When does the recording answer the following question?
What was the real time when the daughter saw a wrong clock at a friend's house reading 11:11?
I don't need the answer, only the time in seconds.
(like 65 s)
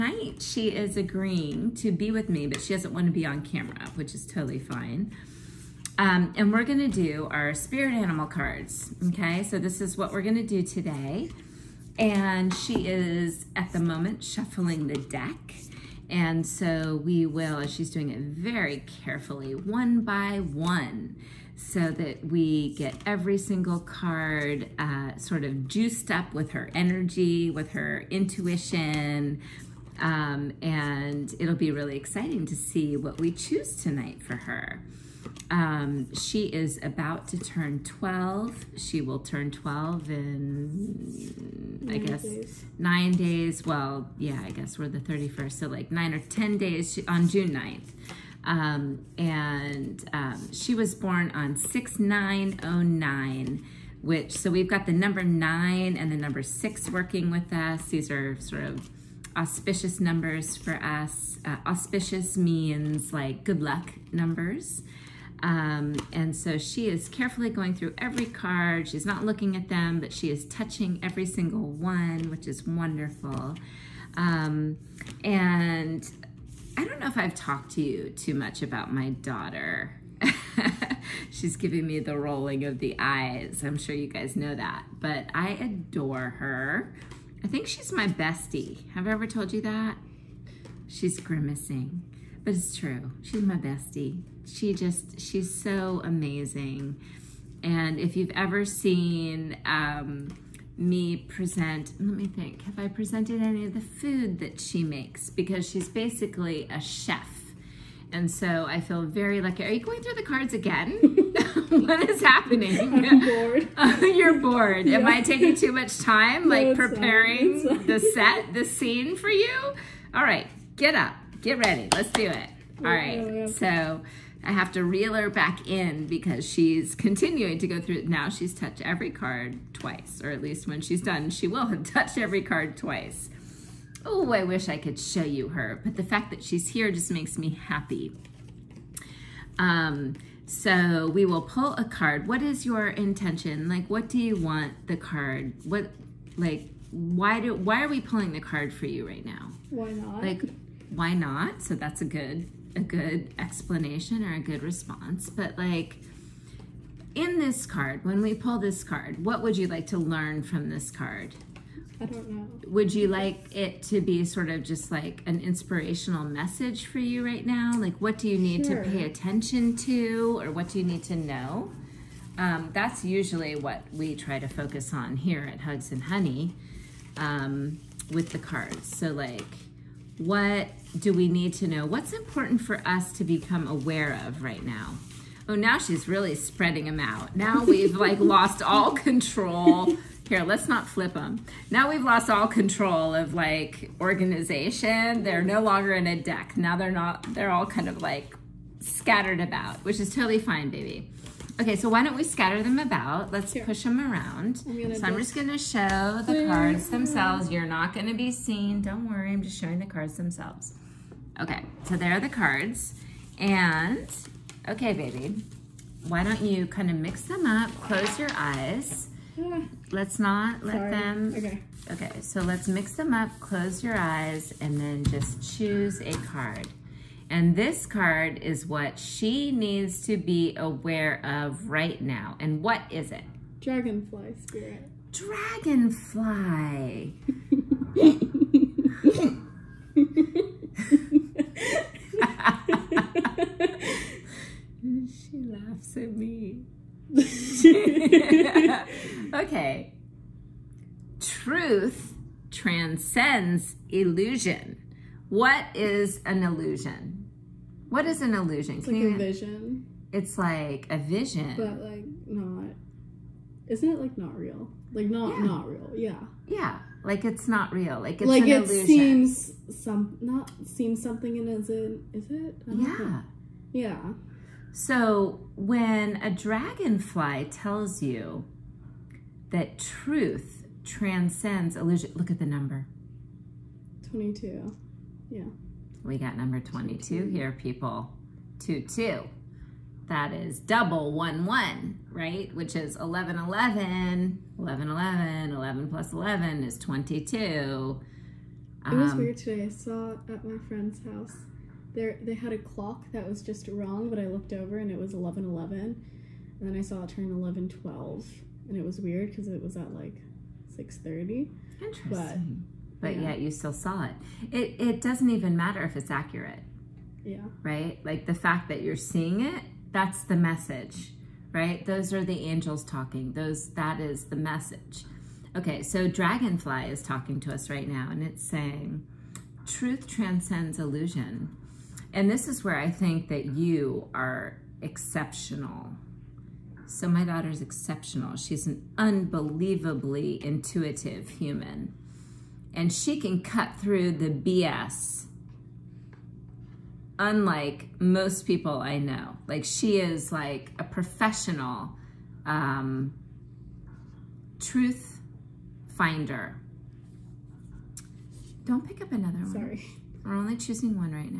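310 s.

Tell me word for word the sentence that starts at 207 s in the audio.
You're not going to be seen.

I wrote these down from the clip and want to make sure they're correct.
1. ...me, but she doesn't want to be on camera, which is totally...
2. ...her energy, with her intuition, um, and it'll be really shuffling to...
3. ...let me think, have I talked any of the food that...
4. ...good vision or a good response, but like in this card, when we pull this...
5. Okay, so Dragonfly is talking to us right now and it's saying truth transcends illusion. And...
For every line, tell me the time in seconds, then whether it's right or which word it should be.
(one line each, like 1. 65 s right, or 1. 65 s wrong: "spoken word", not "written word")
1. 2 s right
2. 26 s wrong: "exciting", not "shuffling"
3. 101 s wrong: "presented", not "talked"
4. 152 s wrong: "explanation", not "vision"
5. 325 s right.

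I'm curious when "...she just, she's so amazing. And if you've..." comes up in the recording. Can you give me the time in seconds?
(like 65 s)
94 s.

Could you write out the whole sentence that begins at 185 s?
Oh, now she's really spreading them out.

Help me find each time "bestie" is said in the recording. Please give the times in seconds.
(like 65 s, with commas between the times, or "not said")
88 s, 93 s.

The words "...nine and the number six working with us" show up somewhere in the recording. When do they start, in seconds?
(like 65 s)
55 s.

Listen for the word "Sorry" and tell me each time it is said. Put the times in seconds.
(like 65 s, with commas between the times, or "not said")
220 s, 359 s.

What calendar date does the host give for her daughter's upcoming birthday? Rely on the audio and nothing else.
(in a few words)
June 9th.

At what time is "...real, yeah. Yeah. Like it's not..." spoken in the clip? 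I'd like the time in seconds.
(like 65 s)
265 s.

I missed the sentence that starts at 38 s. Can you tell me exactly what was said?
She will turn 12 in, nine I guess, days.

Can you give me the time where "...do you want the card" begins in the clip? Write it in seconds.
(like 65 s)
144 s.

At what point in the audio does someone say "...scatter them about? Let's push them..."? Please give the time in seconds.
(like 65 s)
202 s.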